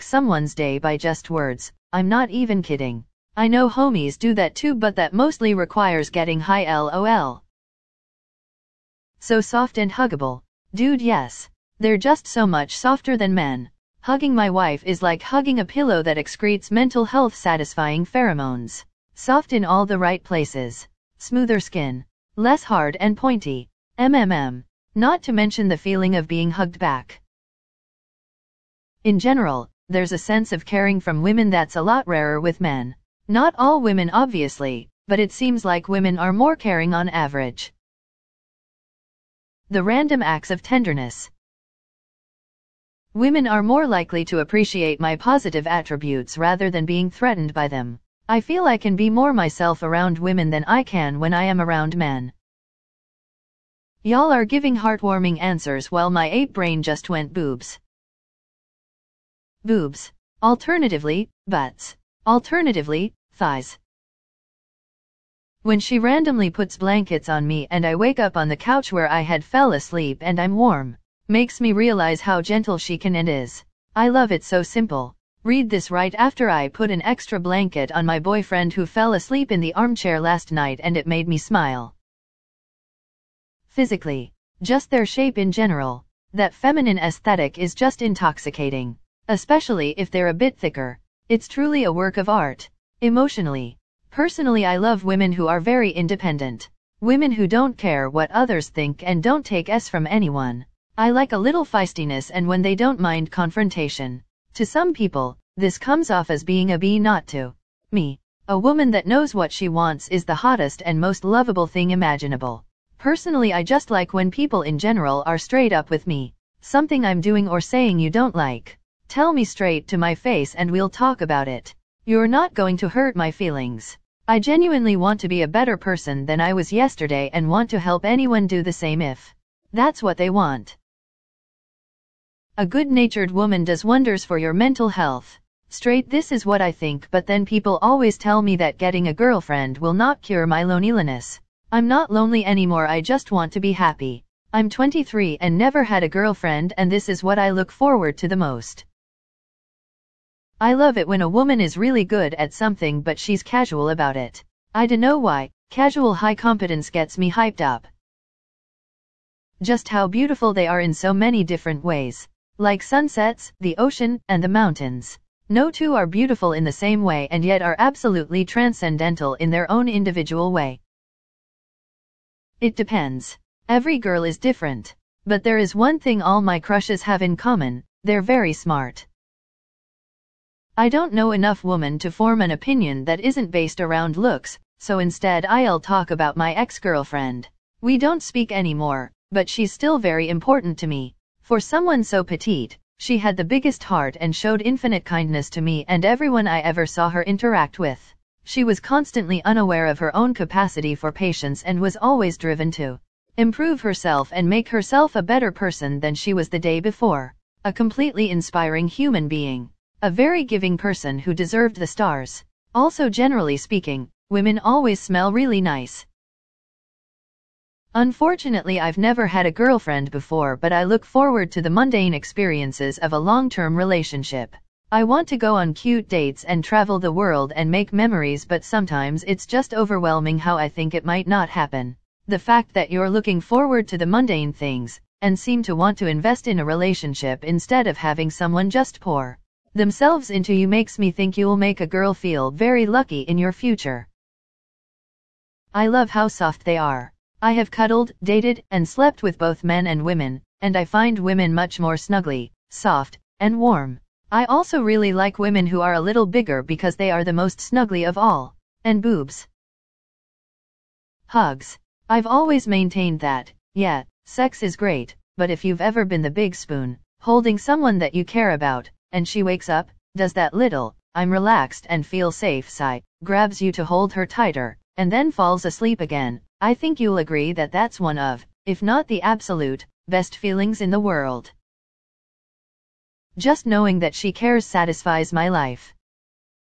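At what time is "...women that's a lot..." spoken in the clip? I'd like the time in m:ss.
0:31.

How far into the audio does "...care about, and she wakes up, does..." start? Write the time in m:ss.
4:28.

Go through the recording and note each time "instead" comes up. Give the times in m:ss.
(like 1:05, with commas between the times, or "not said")
3:04, 3:57.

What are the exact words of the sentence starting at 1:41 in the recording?
I like a little feistiness and when they don't mind confrontation.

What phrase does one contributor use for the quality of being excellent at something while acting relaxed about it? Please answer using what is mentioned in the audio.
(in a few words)
casual high competence.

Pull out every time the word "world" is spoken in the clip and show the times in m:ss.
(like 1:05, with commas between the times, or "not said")
3:47, 4:41.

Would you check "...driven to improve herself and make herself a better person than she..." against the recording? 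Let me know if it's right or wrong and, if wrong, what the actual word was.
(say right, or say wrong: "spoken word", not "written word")
right.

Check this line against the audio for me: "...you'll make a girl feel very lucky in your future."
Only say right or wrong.
right.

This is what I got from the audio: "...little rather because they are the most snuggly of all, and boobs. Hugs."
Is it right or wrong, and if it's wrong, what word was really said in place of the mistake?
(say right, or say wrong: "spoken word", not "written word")
wrong: "bigger", not "rather".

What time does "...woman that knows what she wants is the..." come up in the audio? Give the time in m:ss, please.
1:48.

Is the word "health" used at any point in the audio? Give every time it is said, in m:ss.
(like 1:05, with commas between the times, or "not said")
0:17, 2:14.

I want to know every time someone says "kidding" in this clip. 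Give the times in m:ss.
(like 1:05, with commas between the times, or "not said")
0:02.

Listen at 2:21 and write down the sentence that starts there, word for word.
I'm not lonely anymore I just want to be happy.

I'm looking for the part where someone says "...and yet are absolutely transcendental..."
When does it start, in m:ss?
2:47.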